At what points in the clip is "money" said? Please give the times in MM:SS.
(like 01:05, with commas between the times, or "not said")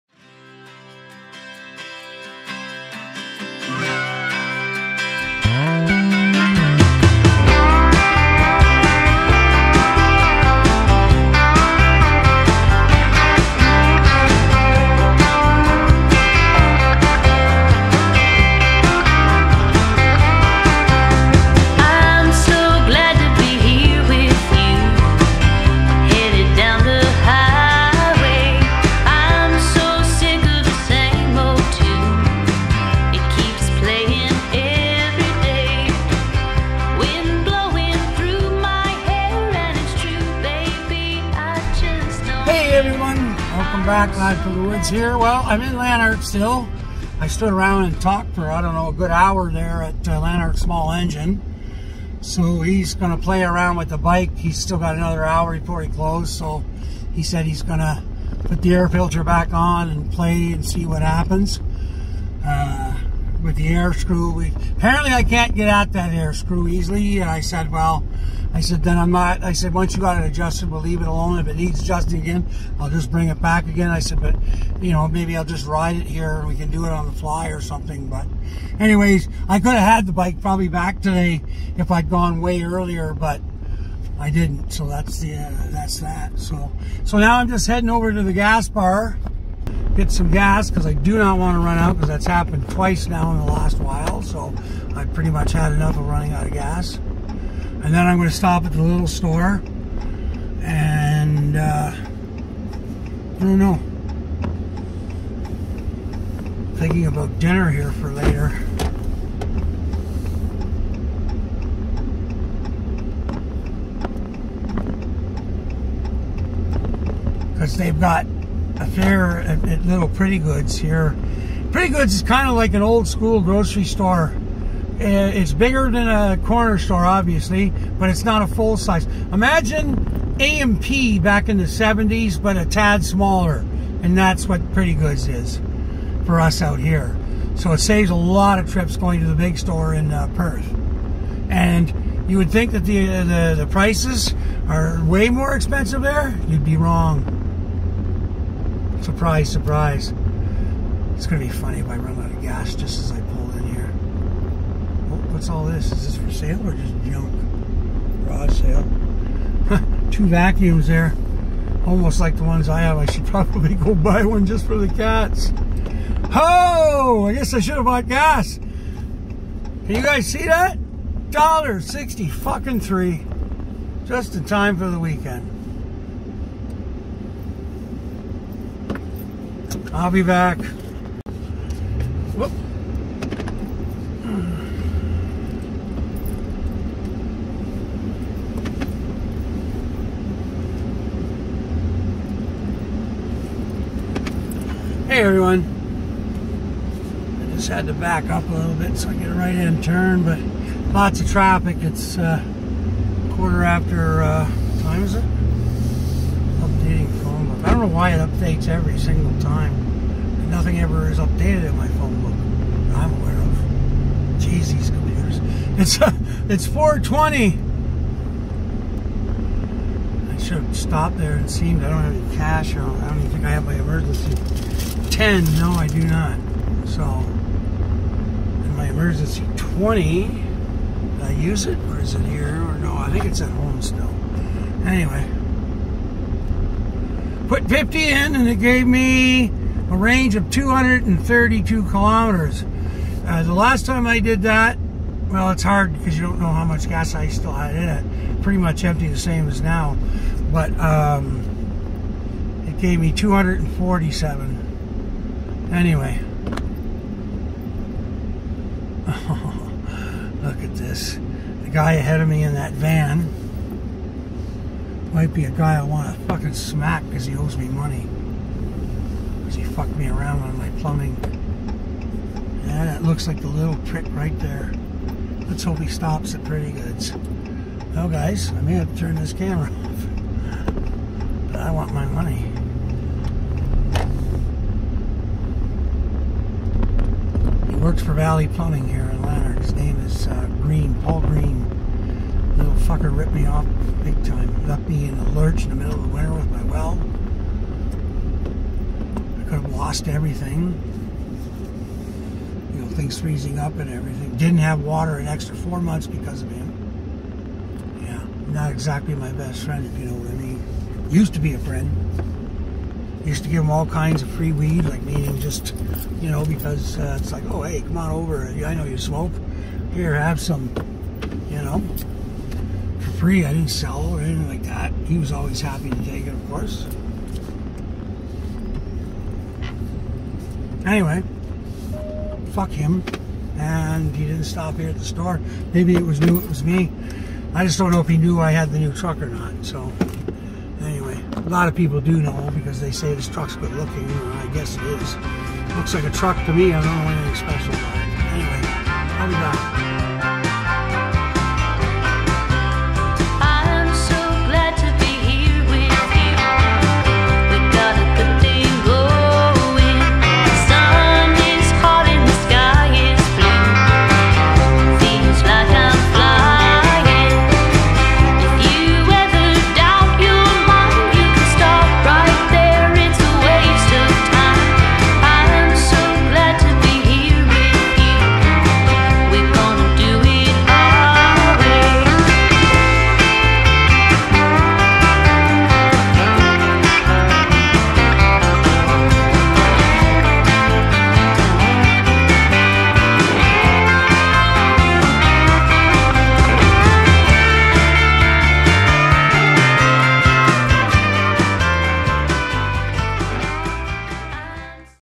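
04:27, 04:42.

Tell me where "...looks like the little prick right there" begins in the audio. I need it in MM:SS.
04:33.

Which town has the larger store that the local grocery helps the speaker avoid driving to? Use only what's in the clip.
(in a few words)
Perth.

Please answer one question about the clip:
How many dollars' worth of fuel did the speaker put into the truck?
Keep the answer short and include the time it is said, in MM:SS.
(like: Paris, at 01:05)
50, at 03:57.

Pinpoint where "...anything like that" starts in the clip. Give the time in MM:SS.
05:24.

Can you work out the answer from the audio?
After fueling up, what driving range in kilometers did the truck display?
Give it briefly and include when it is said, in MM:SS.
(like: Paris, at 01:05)
232, at 04:00.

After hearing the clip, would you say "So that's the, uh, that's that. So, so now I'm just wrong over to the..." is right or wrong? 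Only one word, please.
wrong.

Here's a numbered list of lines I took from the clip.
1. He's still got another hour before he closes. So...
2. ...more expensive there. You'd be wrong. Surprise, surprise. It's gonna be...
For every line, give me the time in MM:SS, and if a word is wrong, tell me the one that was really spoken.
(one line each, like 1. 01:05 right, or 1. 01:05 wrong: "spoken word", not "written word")
1. 00:54 right
2. 02:25 right.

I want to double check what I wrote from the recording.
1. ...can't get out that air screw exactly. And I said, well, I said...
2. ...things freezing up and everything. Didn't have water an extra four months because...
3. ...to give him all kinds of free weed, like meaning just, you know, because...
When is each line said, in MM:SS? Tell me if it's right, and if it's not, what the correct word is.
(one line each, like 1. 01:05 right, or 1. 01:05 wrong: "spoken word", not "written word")
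1. 01:05 wrong: "easily", not "exactly"
2. 05:02 right
3. 05:13 right.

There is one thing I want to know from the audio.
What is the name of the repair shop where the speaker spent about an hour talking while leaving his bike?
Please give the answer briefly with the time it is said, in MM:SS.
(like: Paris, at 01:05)
Lanark Small Engine, at 00:50.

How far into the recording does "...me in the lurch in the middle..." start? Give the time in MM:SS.
04:54.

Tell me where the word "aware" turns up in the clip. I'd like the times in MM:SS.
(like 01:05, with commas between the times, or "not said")
03:33.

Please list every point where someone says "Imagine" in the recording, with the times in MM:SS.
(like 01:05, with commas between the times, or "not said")
02:09.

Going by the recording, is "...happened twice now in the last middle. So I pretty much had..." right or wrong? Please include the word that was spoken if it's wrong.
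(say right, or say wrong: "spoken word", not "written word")
wrong: "while", not "middle".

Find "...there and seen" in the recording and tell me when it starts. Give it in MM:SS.
03:41.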